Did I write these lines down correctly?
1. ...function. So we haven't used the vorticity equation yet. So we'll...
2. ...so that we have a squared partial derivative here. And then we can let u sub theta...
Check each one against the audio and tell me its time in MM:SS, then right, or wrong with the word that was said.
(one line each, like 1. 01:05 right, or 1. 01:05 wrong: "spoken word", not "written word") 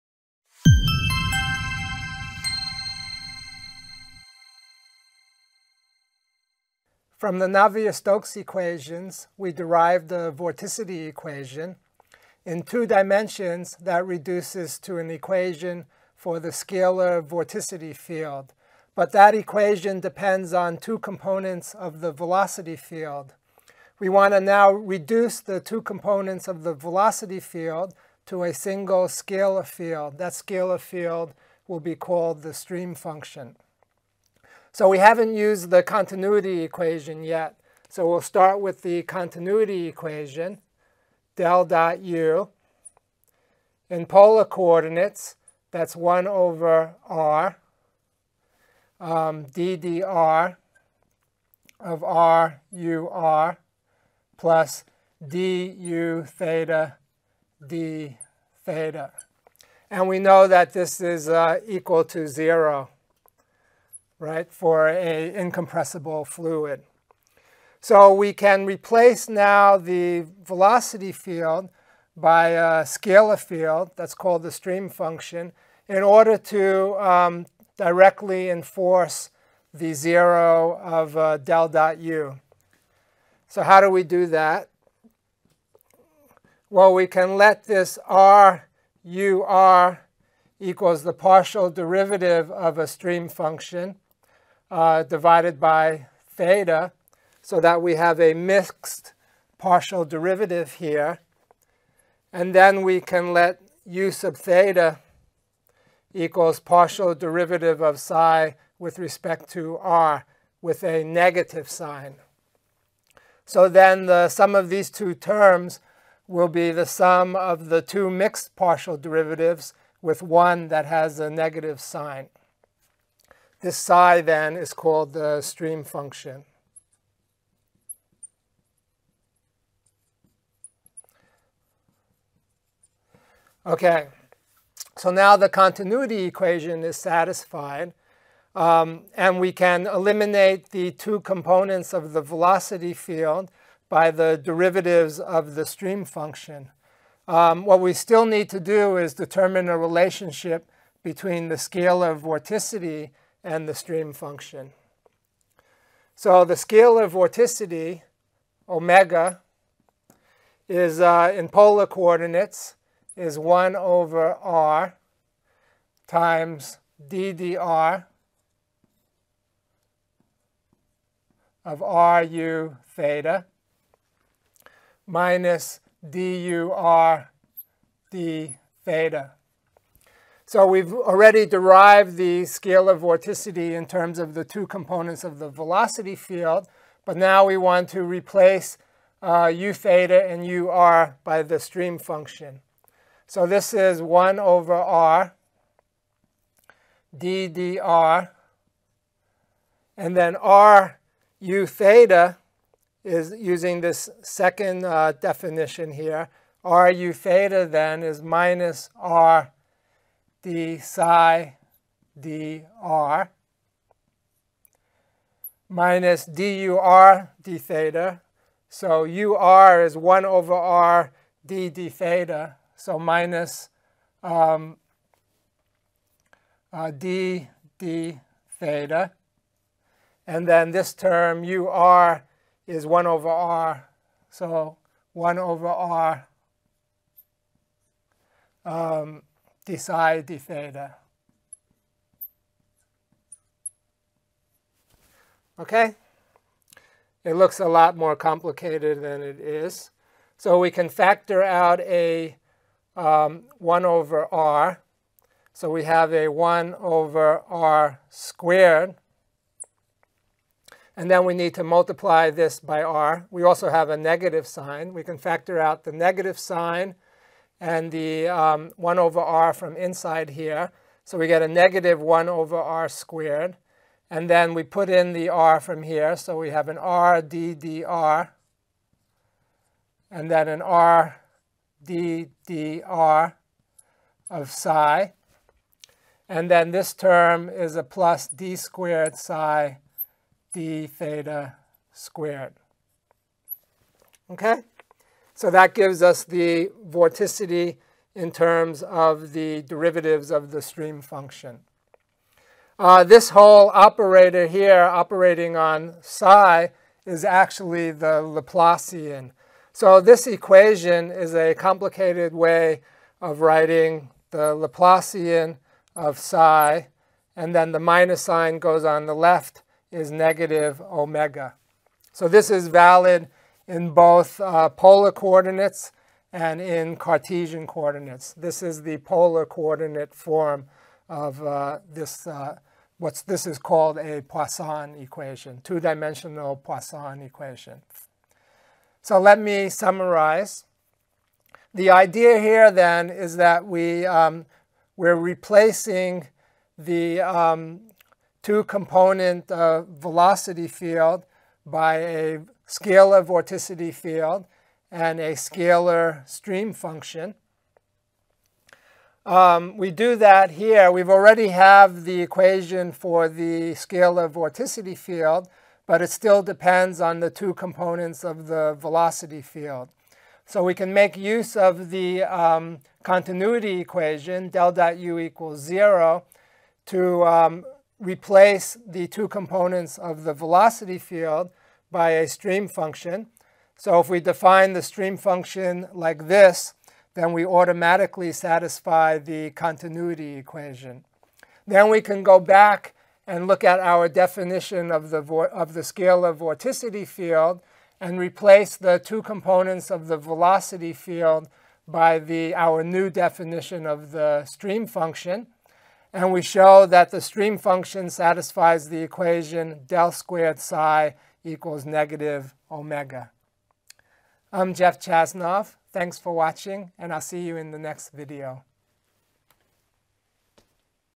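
1. 00:32 wrong: "continuity", not "vorticity"
2. 01:37 wrong: "mixed", not "squared".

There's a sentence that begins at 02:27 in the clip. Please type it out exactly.
Um, what we still need to do is determine a relationship between the scalar vorticity and the stream function.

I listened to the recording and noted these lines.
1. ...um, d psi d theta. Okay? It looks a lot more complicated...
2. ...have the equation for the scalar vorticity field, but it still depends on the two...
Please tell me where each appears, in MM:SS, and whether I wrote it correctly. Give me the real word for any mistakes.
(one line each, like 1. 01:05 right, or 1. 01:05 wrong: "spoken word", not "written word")
1. 03:58 right
2. 06:01 right.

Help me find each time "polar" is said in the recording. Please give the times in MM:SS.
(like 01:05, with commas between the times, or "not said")
00:44, 02:41, 05:24, 05:28.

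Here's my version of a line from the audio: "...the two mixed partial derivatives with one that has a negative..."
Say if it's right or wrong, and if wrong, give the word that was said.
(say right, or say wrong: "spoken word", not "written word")
right.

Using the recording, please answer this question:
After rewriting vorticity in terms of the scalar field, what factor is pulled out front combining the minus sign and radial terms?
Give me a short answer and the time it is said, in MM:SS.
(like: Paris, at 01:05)
-1/r^2, at 04:31.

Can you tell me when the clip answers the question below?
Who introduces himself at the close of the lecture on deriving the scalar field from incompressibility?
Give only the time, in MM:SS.
06:54.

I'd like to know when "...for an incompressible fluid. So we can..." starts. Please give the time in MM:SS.
01:04.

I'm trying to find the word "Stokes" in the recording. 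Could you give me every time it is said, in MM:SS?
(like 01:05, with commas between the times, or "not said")
00:07.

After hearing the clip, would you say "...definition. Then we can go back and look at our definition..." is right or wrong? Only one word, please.
wrong.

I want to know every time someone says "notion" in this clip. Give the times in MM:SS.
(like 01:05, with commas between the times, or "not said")
not said.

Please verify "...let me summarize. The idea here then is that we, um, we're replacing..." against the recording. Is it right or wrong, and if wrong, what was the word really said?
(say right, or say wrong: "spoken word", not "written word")
right.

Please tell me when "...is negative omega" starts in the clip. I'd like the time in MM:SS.
05:19.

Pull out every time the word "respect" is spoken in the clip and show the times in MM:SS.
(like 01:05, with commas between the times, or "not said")
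01:48.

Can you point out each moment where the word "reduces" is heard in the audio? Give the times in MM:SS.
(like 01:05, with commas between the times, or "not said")
00:14, 00:24.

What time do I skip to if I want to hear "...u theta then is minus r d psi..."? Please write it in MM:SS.
03:26.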